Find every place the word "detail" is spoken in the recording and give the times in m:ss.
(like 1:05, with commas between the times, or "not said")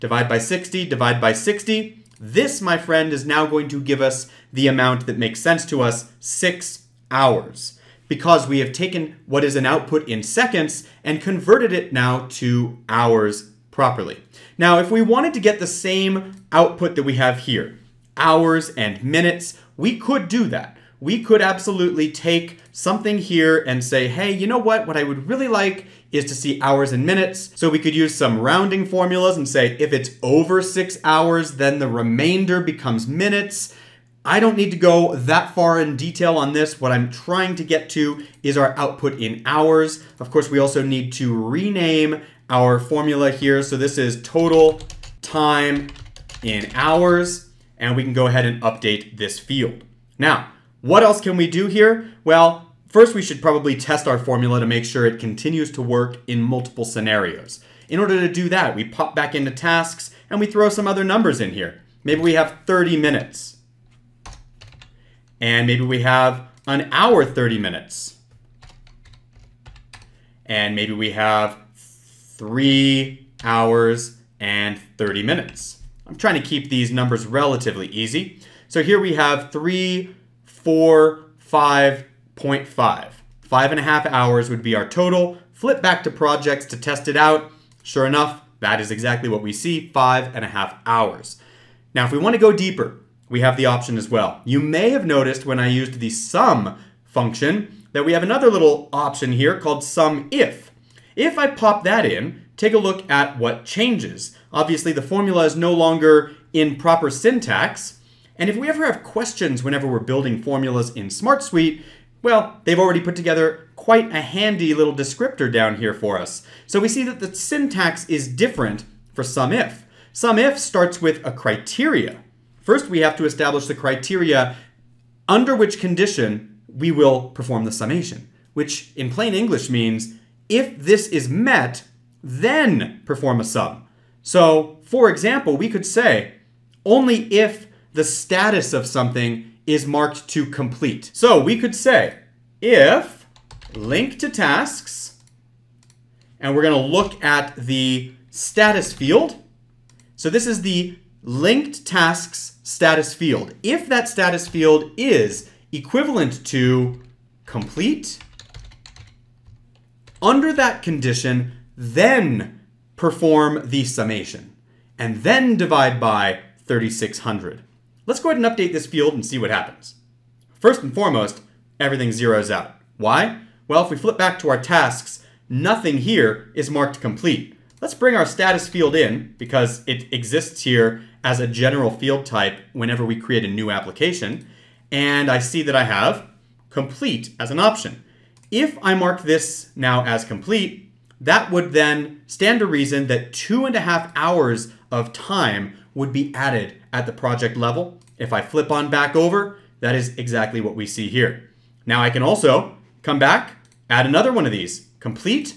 0:35.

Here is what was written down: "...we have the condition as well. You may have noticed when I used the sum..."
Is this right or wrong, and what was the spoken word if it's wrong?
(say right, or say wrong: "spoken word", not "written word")
wrong: "option", not "condition".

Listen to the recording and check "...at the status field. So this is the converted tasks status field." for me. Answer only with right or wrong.
wrong.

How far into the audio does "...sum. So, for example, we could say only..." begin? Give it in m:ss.
2:13.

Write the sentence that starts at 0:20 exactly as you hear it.
We could absolutely take something here and say, hey, you know what?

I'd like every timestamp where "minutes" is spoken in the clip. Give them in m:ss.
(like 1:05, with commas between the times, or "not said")
0:19, 0:27, 0:33, 1:02, 1:07, 1:15.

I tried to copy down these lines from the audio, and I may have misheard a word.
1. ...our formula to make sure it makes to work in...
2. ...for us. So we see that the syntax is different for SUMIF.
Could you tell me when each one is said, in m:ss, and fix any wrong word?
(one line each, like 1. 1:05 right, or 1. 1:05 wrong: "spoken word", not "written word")
1. 0:54 wrong: "continues", not "makes"
2. 1:55 right.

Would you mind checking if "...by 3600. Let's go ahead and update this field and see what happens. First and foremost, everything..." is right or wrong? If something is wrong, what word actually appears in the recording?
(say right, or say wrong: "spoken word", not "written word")
right.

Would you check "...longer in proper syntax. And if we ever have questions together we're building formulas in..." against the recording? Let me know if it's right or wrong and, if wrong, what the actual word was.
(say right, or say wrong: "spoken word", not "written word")
wrong: "whenever", not "together".